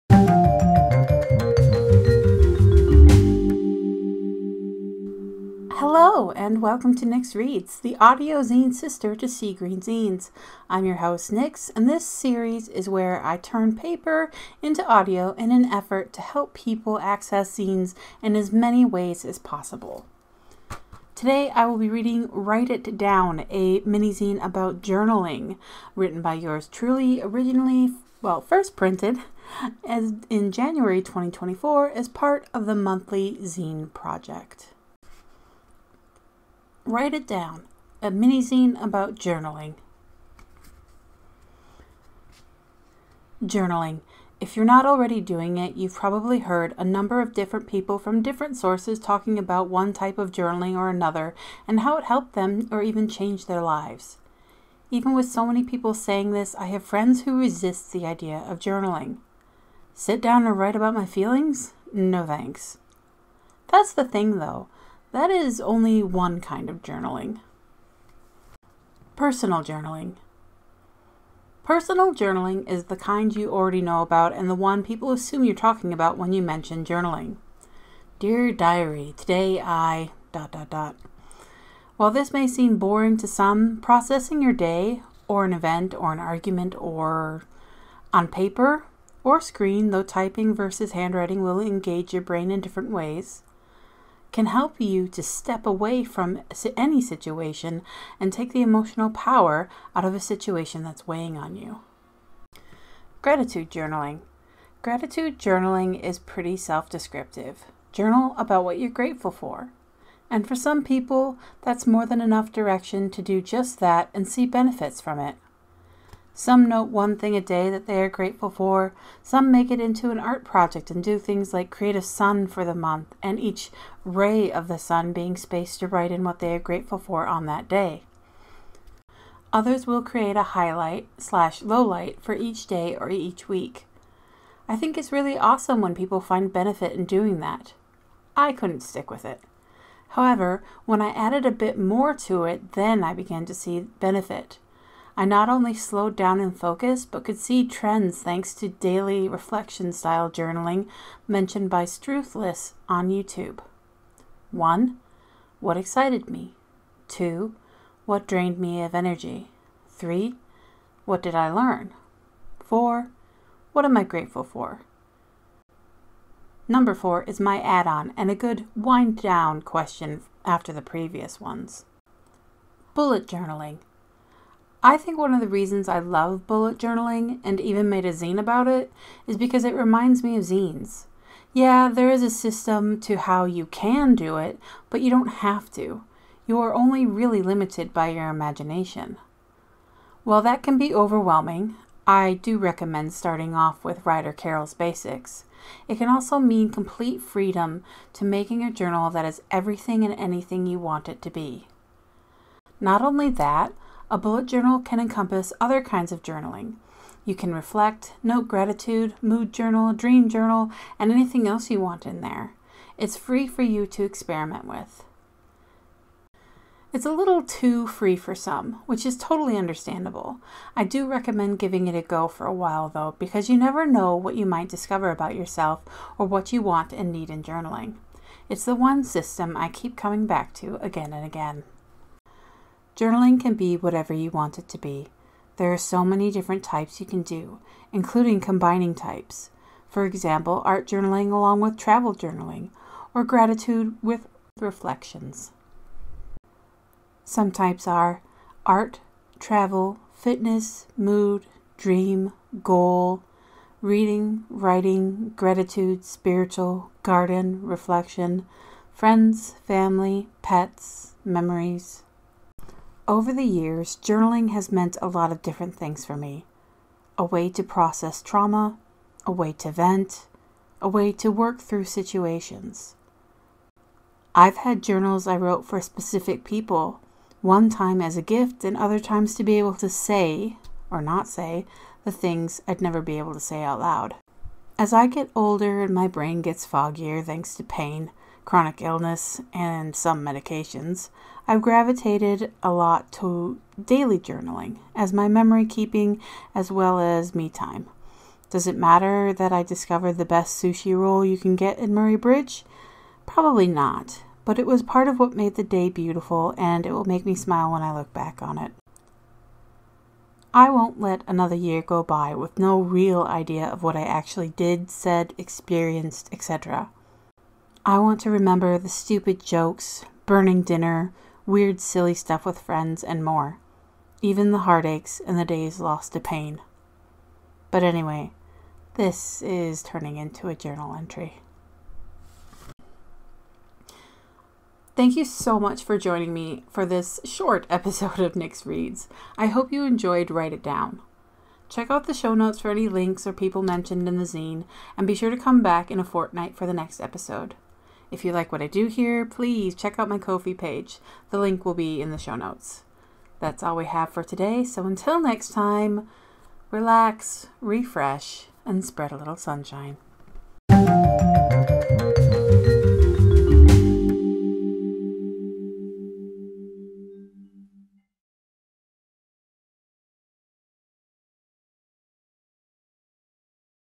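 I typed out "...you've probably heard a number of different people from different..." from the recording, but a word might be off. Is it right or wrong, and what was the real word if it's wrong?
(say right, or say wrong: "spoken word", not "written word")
right.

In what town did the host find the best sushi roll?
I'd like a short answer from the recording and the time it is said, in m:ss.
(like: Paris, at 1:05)
Murray Bridge, at 5:01.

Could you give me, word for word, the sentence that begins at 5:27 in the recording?
But anyway, this is turning into a journal entry.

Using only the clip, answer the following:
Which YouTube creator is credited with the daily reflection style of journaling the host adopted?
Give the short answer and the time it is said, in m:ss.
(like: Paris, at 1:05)
Struthless, at 2:31.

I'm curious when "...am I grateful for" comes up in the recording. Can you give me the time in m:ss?
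2:43.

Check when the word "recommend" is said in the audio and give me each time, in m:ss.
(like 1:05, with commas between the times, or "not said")
3:12, 3:41.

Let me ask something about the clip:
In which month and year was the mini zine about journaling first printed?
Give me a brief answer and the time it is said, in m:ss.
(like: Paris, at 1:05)
January 2024, at 0:30.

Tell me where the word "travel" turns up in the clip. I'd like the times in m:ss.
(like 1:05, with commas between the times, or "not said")
4:01, 4:09.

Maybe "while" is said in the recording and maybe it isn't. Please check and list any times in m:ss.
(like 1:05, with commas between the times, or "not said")
1:21, 3:10, 3:42.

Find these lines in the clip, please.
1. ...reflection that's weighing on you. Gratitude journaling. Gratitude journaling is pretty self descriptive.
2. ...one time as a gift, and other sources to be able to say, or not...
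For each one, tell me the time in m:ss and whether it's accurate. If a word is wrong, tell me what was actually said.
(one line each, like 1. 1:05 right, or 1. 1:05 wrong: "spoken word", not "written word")
1. 1:40 wrong: "situation", not "reflection"
2. 4:37 wrong: "times", not "sources".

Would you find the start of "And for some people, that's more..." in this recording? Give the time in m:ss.
1:50.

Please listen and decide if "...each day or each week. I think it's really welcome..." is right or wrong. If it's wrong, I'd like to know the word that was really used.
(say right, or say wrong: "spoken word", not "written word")
wrong: "awesome", not "welcome".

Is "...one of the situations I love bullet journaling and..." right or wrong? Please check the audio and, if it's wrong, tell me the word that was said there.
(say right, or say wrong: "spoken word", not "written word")
wrong: "reasons", not "situations".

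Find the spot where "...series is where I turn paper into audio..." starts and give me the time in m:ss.
0:12.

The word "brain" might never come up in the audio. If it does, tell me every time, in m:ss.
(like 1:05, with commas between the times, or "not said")
1:32, 4:46.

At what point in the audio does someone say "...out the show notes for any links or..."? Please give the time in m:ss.
5:41.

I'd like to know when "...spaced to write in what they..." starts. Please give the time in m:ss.
2:05.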